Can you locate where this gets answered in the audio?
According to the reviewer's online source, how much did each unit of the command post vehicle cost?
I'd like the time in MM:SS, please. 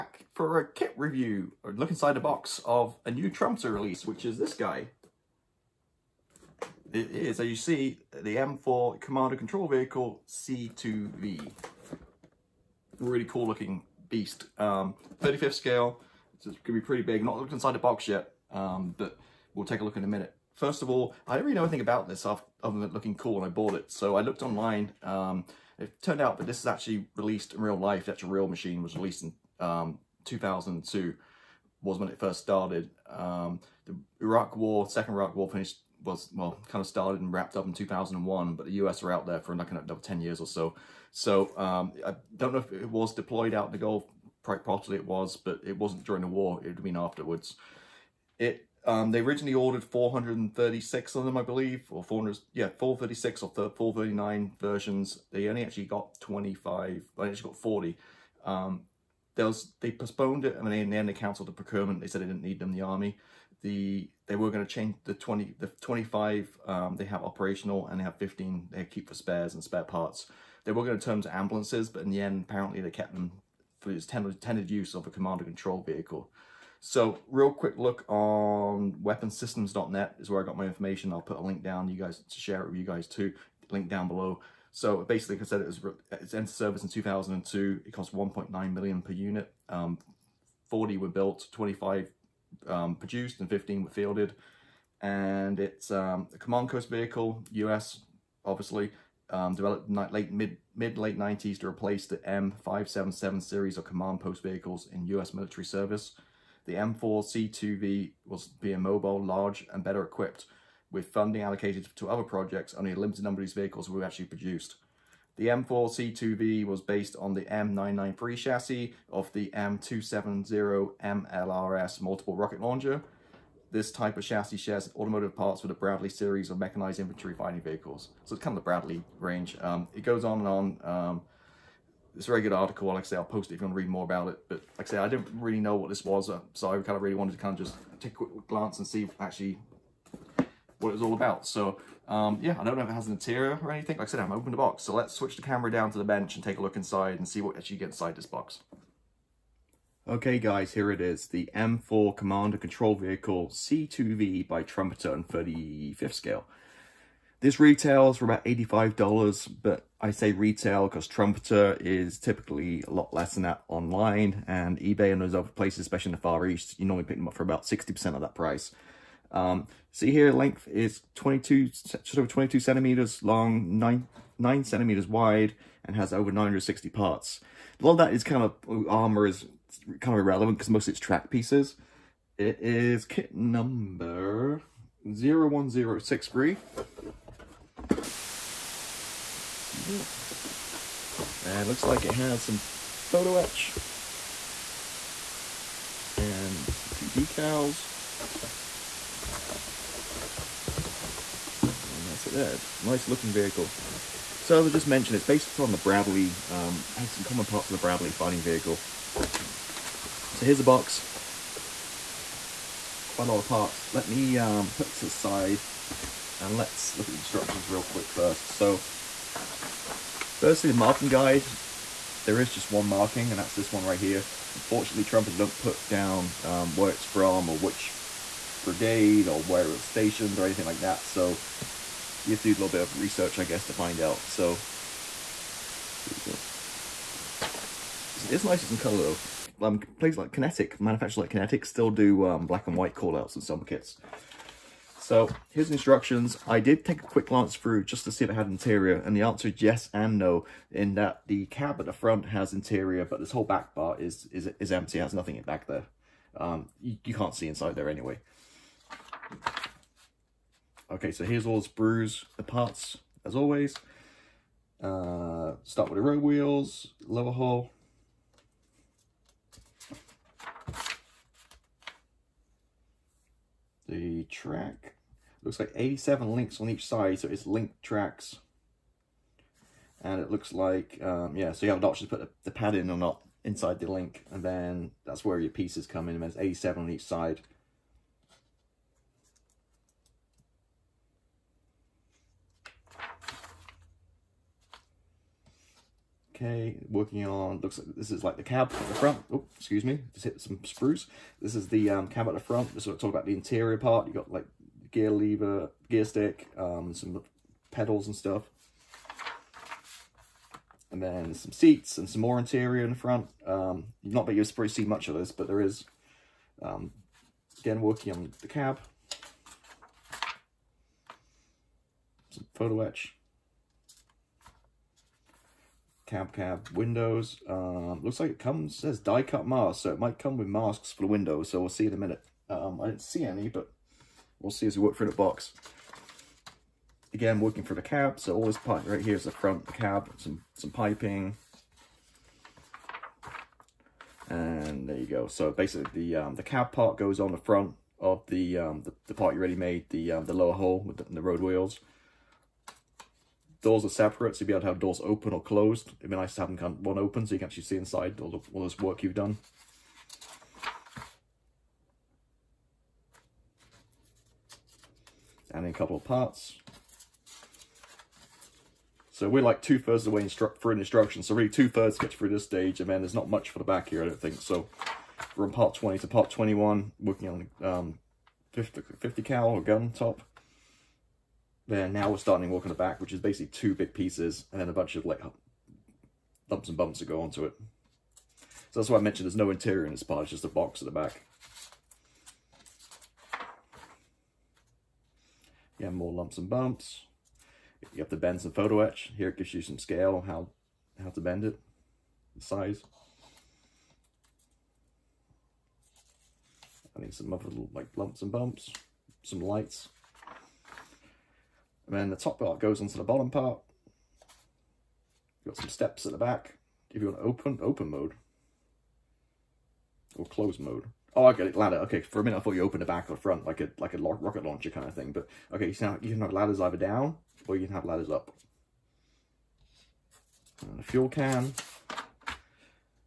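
01:28.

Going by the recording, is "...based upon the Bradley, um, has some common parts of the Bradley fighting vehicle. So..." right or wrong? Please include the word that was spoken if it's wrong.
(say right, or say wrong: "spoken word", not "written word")
right.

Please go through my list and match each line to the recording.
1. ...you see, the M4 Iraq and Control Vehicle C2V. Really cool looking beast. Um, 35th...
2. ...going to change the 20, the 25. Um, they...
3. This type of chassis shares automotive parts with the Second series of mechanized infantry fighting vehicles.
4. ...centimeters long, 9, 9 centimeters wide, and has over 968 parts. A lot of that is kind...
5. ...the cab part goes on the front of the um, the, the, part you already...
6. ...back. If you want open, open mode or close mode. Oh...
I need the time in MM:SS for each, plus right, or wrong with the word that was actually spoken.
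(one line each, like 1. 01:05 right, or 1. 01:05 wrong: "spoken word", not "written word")
1. 00:07 wrong: "Command", not "Iraq"
2. 01:04 right
3. 02:03 wrong: "Bradley", not "Second"
4. 02:52 wrong: "960", not "968"
5. 05:46 right
6. 06:56 right.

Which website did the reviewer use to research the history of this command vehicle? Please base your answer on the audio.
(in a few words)
weaponsystems.net.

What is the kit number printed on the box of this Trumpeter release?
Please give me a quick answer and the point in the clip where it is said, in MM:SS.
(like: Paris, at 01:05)
01063, at 03:05.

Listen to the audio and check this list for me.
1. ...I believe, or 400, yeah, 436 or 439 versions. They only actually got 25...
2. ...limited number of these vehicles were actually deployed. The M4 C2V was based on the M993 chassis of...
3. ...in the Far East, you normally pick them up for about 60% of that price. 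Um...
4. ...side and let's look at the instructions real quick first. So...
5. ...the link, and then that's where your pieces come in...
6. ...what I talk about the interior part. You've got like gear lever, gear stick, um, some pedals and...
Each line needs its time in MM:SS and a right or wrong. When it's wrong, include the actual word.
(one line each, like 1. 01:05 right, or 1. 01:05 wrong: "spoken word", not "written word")
1. 00:51 right
2. 01:52 wrong: "produced", not "deployed"
3. 02:46 right
4. 03:35 right
5. 04:43 right
6. 05:02 right.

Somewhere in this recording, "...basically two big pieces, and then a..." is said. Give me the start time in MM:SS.
06:23.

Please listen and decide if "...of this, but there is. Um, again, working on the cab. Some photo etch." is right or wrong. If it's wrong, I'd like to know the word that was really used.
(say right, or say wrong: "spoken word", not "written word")
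right.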